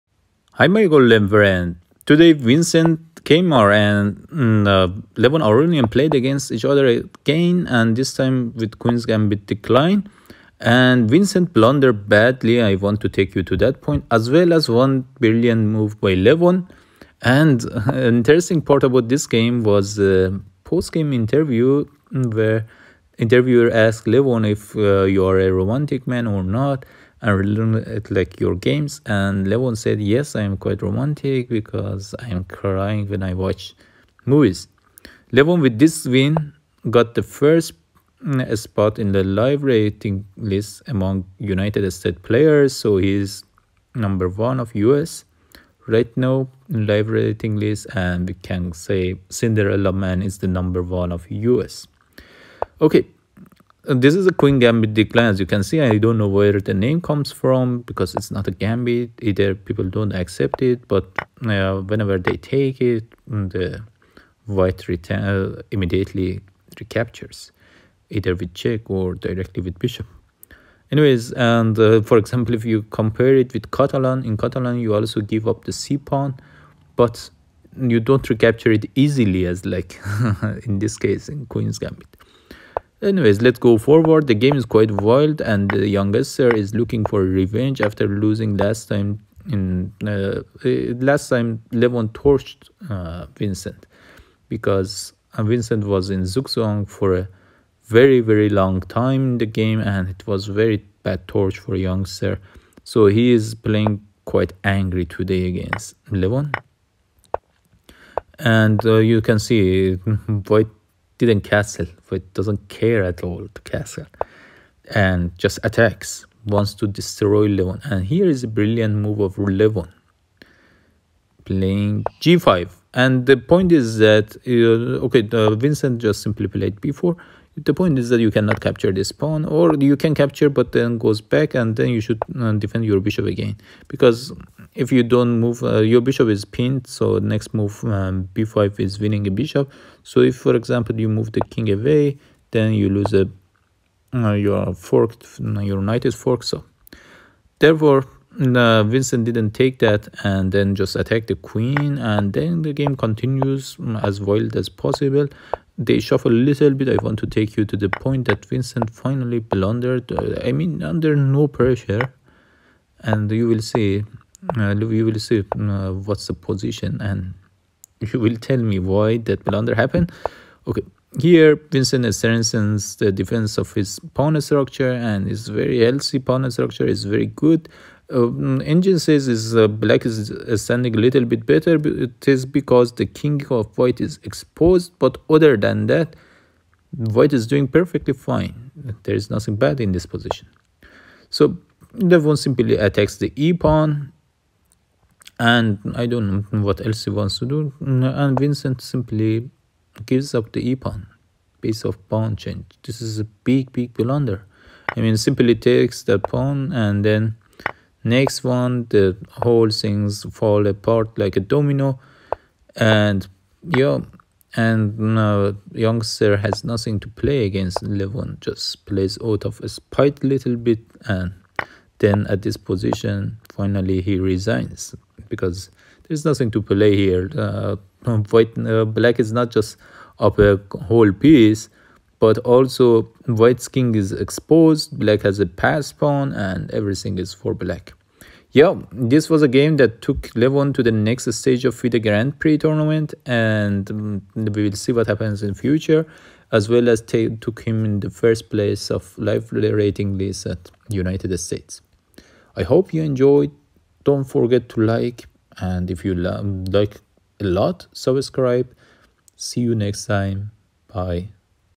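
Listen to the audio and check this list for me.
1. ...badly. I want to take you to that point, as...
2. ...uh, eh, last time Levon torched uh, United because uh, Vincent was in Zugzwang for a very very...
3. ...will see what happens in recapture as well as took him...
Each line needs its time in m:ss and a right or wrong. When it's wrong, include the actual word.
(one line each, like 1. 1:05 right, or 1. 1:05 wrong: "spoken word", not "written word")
1. 0:12 right
2. 1:30 wrong: "Vincent", not "United"
3. 4:04 wrong: "future", not "recapture".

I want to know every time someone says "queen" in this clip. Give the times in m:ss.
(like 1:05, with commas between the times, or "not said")
0:08, 0:54, 1:21, 2:31.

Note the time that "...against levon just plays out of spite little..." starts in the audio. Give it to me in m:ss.
3:37.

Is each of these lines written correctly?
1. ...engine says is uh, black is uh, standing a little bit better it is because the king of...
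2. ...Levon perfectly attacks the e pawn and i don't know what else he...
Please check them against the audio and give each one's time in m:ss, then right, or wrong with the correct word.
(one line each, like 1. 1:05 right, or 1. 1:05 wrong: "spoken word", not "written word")
1. 2:58 right
2. 3:11 wrong: "simply", not "perfectly".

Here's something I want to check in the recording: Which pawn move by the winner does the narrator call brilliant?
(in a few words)
g5.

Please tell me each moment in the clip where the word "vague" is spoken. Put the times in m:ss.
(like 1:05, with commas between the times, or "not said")
not said.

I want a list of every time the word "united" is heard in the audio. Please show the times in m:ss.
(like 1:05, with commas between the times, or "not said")
0:41, 4:10.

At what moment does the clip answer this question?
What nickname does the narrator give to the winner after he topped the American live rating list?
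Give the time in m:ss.
0:49.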